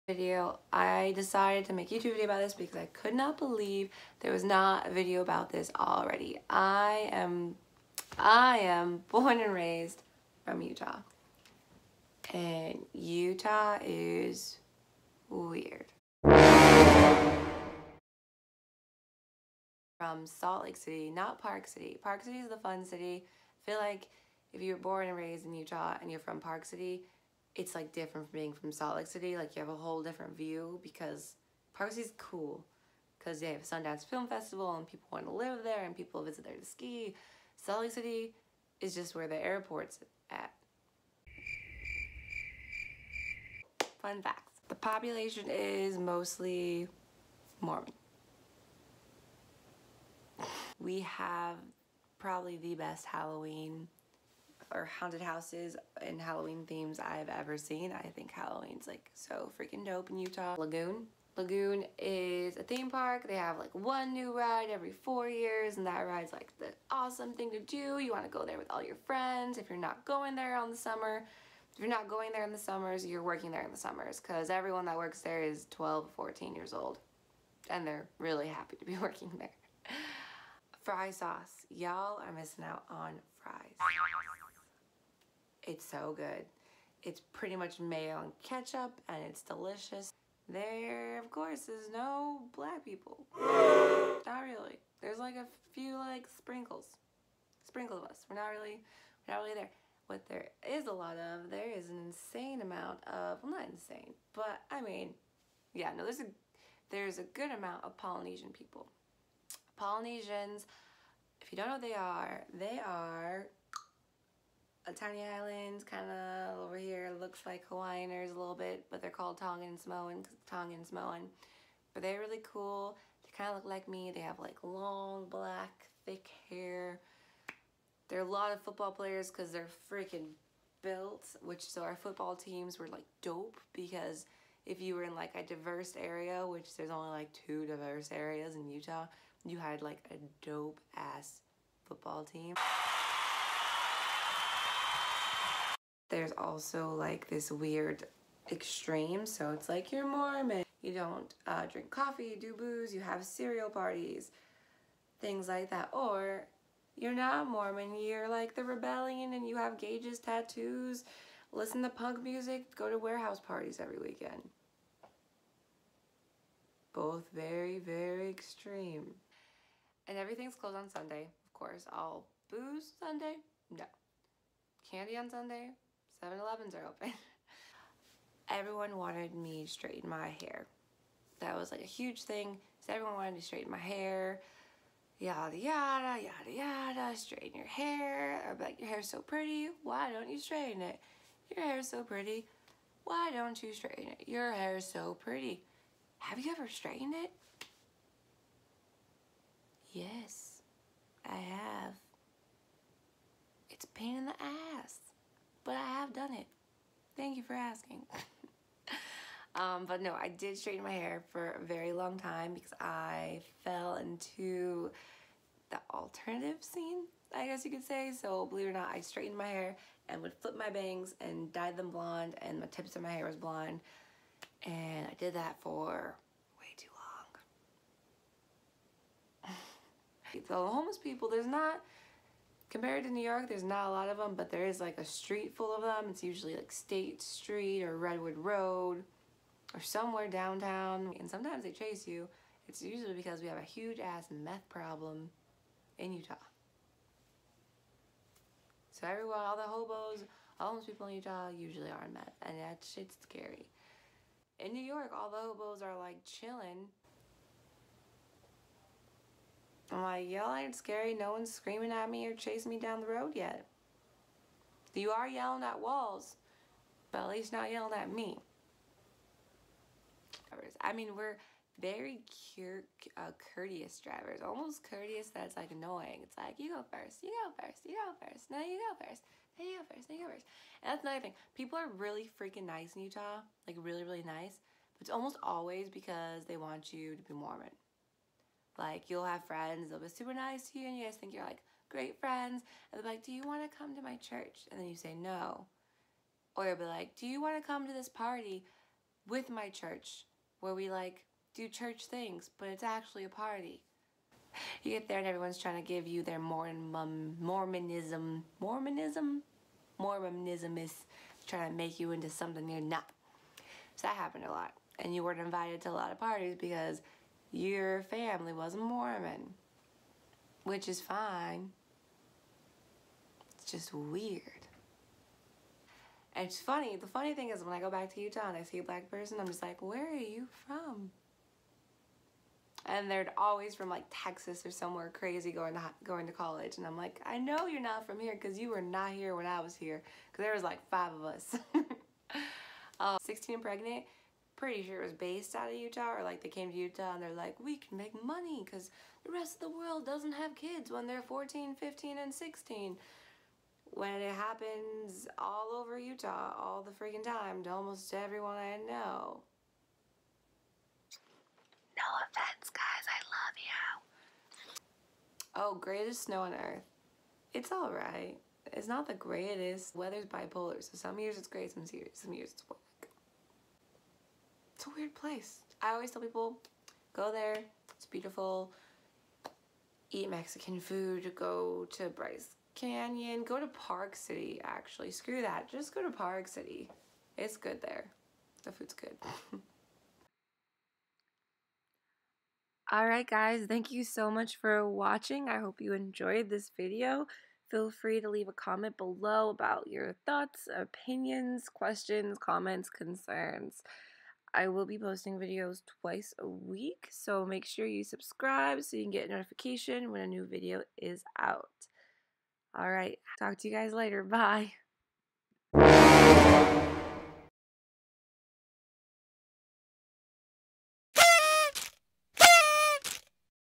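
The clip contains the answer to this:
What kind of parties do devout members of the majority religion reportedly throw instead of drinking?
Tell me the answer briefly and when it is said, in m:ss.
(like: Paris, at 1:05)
Cereal parties, at 2:33.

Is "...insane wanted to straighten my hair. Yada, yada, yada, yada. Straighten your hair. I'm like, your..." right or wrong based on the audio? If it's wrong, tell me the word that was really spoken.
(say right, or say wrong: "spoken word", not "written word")
wrong: "everyone", not "insane".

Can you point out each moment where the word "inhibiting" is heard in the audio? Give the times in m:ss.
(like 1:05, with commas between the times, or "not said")
not said.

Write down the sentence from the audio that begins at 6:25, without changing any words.
Screw that, just go to Park City.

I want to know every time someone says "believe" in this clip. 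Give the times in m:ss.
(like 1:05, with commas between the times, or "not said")
0:03, 3:38.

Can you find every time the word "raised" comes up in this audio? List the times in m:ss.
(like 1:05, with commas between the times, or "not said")
0:09, 0:25.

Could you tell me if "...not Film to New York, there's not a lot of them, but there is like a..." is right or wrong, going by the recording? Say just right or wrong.
wrong.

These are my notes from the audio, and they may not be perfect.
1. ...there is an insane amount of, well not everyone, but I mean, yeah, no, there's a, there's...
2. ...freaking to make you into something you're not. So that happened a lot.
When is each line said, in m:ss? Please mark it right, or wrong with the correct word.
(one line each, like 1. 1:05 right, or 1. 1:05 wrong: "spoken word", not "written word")
1. 1:41 wrong: "insane", not "everyone"
2. 5:11 wrong: "trying", not "freaking".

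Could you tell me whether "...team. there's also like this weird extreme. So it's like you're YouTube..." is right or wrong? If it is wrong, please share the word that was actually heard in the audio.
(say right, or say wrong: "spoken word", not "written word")
wrong: "Mormon", not "YouTube".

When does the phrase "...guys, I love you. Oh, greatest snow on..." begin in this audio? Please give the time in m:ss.
6:02.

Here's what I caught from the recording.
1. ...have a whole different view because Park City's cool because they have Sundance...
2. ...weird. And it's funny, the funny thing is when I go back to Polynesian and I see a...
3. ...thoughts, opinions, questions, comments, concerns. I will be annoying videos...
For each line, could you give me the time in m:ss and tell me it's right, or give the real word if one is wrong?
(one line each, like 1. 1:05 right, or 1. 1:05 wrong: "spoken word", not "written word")
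1. 0:29 right
2. 5:23 wrong: "Utah", not "Polynesian"
3. 6:40 wrong: "posting", not "annoying".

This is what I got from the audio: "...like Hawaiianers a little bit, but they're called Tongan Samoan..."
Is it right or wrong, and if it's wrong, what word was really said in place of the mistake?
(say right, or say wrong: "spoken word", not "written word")
right.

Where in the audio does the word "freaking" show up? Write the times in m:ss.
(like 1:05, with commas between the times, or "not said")
0:59, 2:09, 4:42, 5:56.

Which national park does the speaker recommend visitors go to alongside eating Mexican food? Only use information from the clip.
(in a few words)
Bryce Canyon.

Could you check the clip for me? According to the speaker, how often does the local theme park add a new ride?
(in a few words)
Every 4 years.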